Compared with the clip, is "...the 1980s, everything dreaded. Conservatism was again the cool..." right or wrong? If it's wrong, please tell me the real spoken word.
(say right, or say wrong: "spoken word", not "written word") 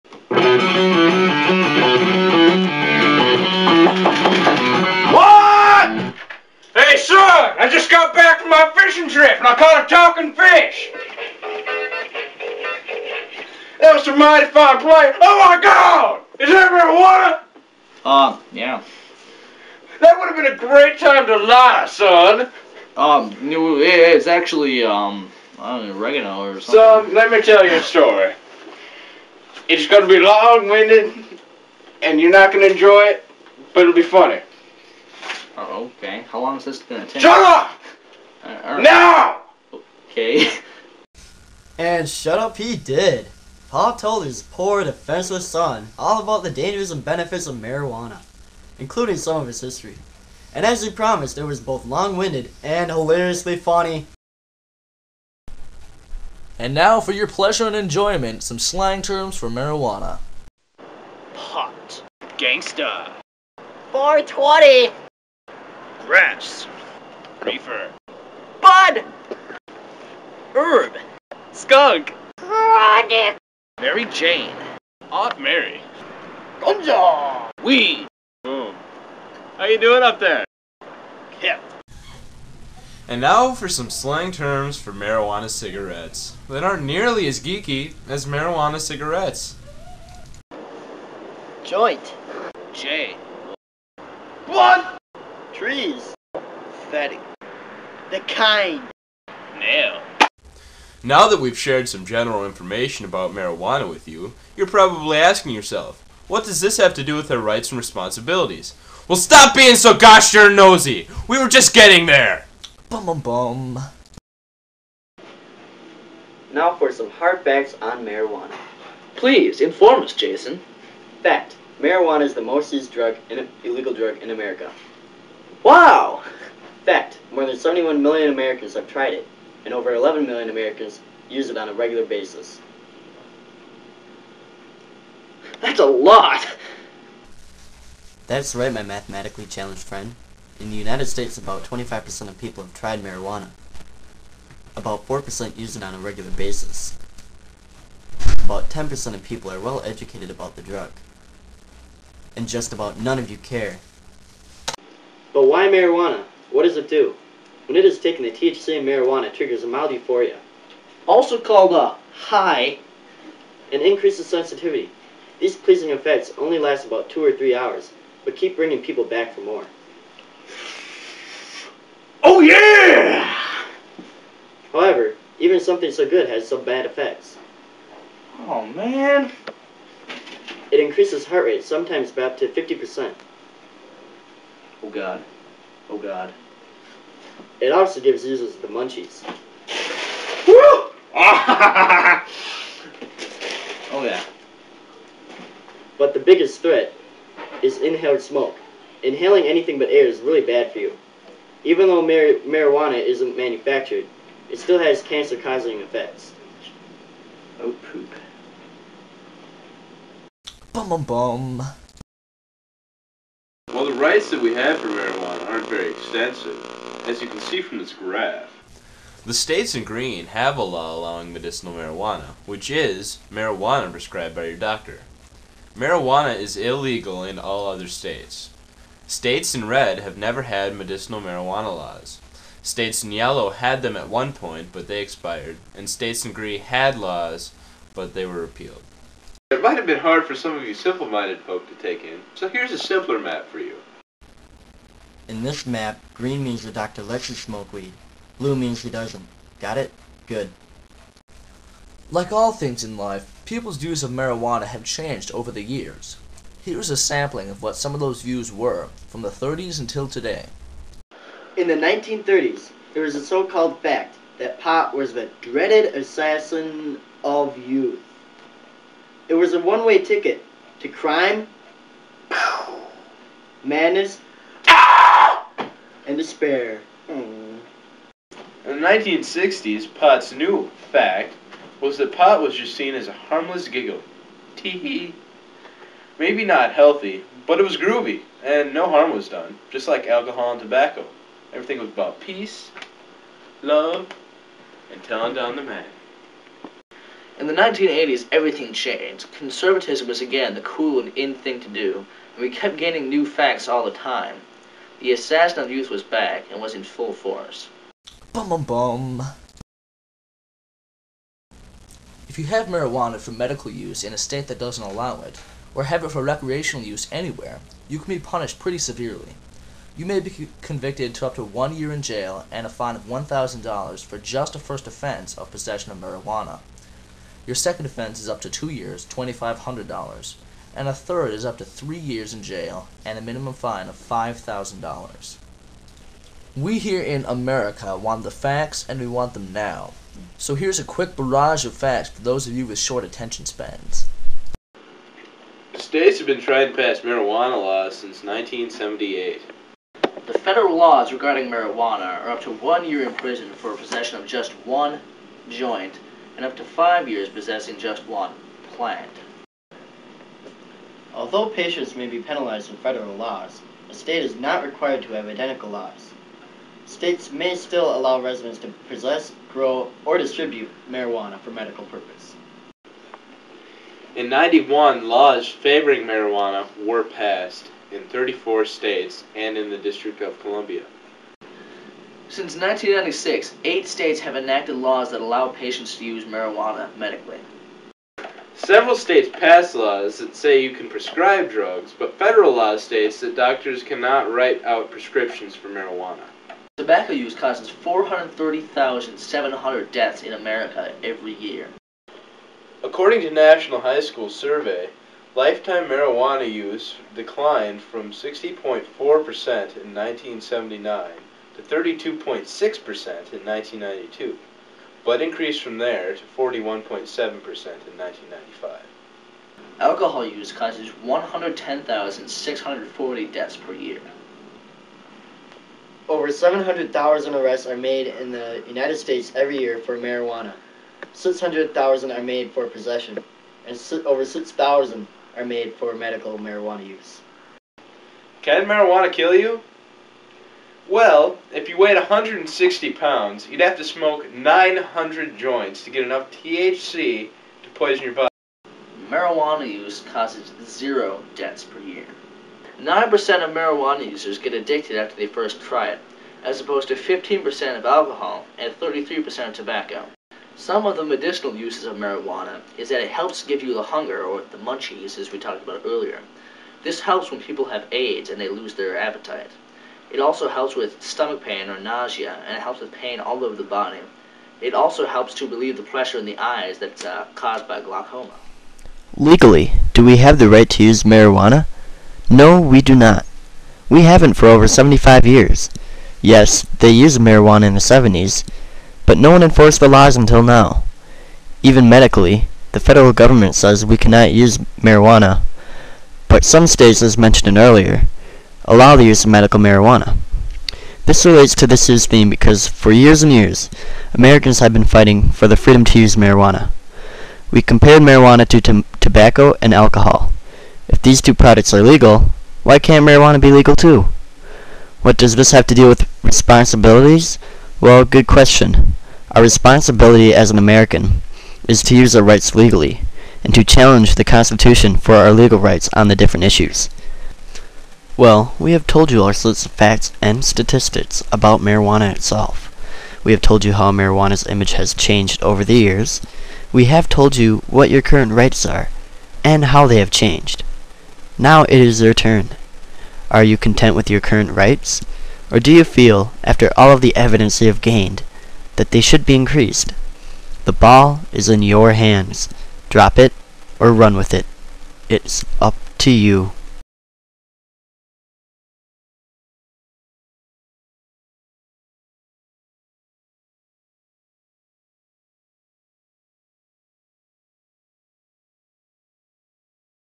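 wrong: "changed", not "dreaded".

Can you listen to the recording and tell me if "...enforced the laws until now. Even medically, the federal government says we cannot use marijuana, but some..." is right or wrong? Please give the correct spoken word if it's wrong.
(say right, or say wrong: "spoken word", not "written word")
right.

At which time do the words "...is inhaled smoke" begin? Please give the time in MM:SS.
03:17.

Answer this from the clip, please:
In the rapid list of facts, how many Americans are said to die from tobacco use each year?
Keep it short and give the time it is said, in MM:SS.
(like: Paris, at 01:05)
430,700, at 06:37.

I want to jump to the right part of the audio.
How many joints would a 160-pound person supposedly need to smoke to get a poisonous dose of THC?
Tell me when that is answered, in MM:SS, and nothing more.
07:24.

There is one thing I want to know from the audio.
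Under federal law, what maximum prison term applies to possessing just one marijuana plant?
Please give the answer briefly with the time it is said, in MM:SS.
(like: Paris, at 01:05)
five years, at 05:56.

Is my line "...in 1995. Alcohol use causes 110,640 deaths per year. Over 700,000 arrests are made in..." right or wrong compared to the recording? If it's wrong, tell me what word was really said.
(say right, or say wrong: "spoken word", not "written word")
right.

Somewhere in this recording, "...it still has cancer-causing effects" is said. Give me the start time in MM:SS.
03:24.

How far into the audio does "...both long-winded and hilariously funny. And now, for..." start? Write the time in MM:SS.
00:51.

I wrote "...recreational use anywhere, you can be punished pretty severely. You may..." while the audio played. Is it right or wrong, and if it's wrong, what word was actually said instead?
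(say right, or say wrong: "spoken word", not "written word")
right.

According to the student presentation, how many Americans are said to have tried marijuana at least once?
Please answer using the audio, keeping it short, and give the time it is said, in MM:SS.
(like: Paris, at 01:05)
more than 71 million, at 02:07.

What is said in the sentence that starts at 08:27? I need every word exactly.
We compared marijuana to tobacco and alcohol.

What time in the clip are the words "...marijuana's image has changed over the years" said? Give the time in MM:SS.
08:53.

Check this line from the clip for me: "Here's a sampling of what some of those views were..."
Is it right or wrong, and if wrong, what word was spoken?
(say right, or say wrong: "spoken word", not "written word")
right.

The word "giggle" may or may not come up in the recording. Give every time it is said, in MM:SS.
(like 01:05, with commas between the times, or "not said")
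04:43.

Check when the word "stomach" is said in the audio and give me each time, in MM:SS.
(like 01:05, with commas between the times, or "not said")
07:51.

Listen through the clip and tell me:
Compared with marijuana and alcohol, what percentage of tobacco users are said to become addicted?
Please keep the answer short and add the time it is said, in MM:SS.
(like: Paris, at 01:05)
33%, at 07:38.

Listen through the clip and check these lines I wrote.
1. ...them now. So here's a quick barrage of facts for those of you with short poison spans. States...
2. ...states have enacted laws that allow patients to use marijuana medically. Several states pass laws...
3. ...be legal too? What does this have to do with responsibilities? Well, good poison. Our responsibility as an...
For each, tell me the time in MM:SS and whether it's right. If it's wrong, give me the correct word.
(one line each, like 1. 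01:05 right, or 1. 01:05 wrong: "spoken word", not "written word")
1. 05:39 wrong: "attention", not "poison"
2. 06:23 right
3. 08:33 wrong: "question", not "poison".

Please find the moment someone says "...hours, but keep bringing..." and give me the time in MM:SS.
02:47.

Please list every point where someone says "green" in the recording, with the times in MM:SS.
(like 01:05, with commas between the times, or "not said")
03:39, 03:56, 04:06.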